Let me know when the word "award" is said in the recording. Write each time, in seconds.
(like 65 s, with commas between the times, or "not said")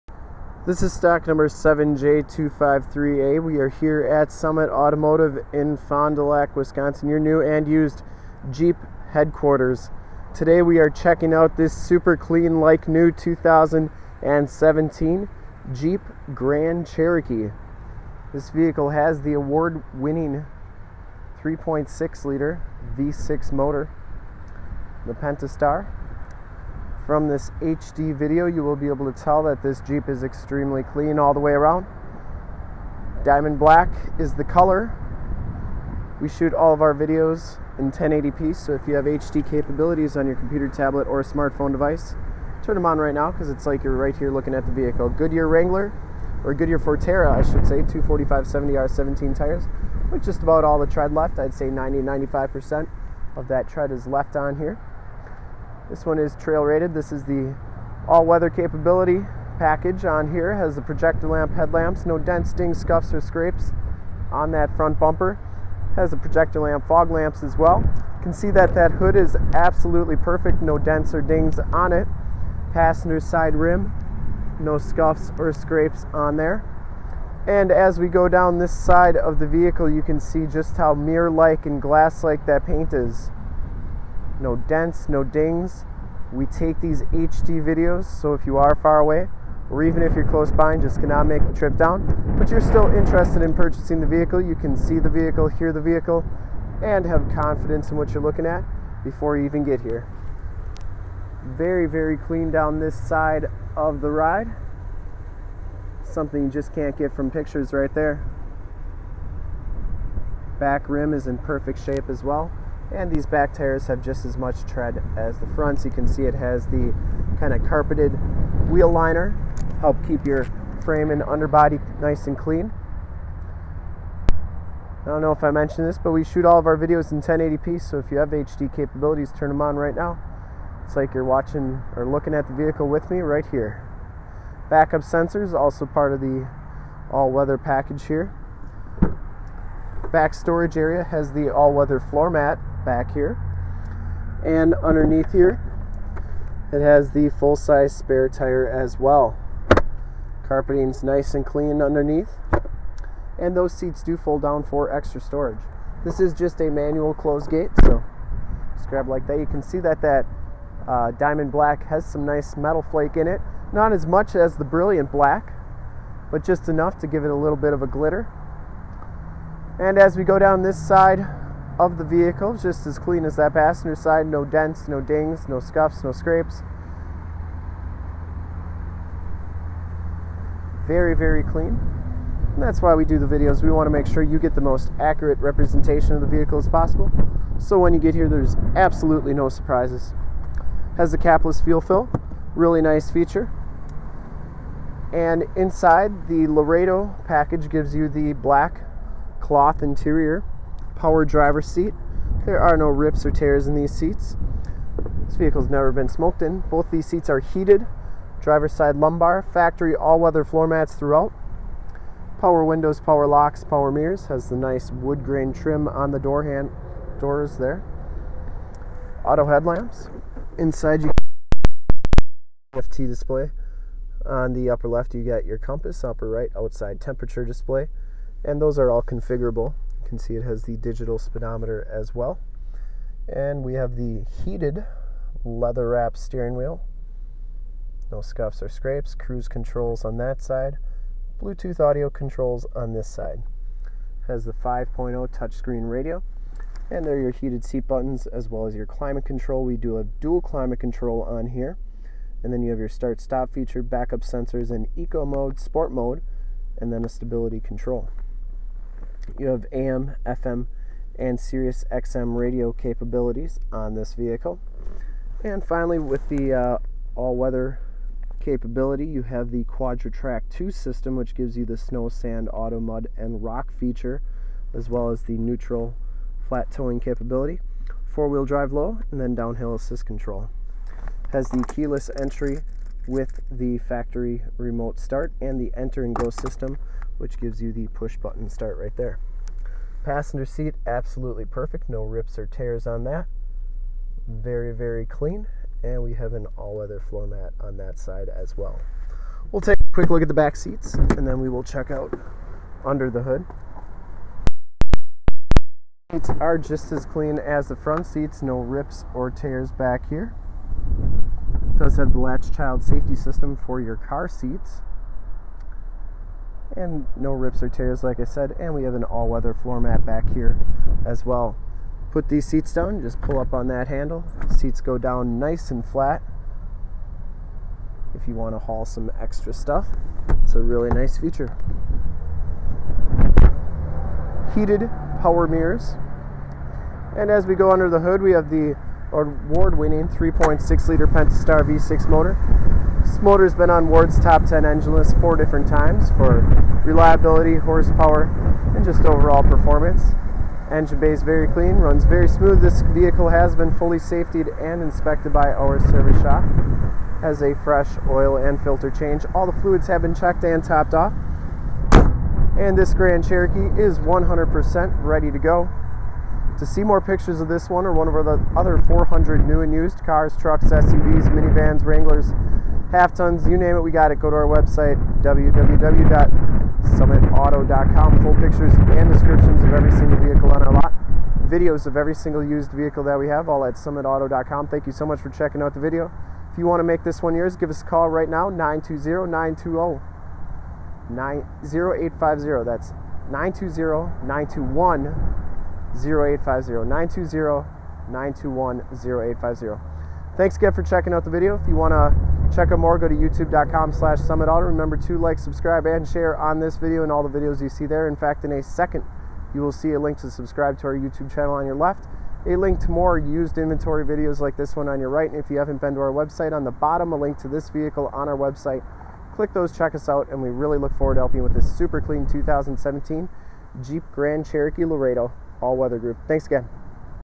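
19 s, 339 s.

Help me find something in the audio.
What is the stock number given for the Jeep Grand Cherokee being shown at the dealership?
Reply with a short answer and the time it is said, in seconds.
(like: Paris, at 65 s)
7J253A, at 1 s.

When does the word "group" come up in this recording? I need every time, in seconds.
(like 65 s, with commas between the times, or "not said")
425 s.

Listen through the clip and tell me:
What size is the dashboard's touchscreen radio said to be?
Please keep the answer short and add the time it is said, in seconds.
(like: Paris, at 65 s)
5.0, at 244 s.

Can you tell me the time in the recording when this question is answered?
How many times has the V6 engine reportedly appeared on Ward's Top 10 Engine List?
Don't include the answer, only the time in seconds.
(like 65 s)
345 s.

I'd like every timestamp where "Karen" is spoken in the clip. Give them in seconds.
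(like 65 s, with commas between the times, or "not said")
not said.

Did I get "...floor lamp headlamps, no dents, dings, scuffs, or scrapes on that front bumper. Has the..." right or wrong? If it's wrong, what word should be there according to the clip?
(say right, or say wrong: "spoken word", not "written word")
wrong: "projector", not "floor".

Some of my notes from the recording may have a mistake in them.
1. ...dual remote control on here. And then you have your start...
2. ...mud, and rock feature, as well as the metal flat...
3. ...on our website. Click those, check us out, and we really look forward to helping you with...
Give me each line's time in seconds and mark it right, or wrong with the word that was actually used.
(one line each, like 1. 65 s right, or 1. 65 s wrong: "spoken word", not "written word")
1. 250 s wrong: "climate", not "remote"
2. 272 s wrong: "neutral", not "metal"
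3. 418 s right.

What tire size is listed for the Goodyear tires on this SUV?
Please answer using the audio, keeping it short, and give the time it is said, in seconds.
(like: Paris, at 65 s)
245 70R17, at 47 s.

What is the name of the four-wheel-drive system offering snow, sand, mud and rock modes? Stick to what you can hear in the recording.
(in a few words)
Quadra-Trac 2.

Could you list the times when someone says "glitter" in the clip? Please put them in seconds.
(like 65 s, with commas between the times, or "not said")
167 s.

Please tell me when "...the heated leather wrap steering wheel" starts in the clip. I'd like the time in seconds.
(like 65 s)
233 s.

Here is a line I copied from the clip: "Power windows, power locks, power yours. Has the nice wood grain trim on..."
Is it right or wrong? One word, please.
wrong.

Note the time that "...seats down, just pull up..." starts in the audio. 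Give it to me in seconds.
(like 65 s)
322 s.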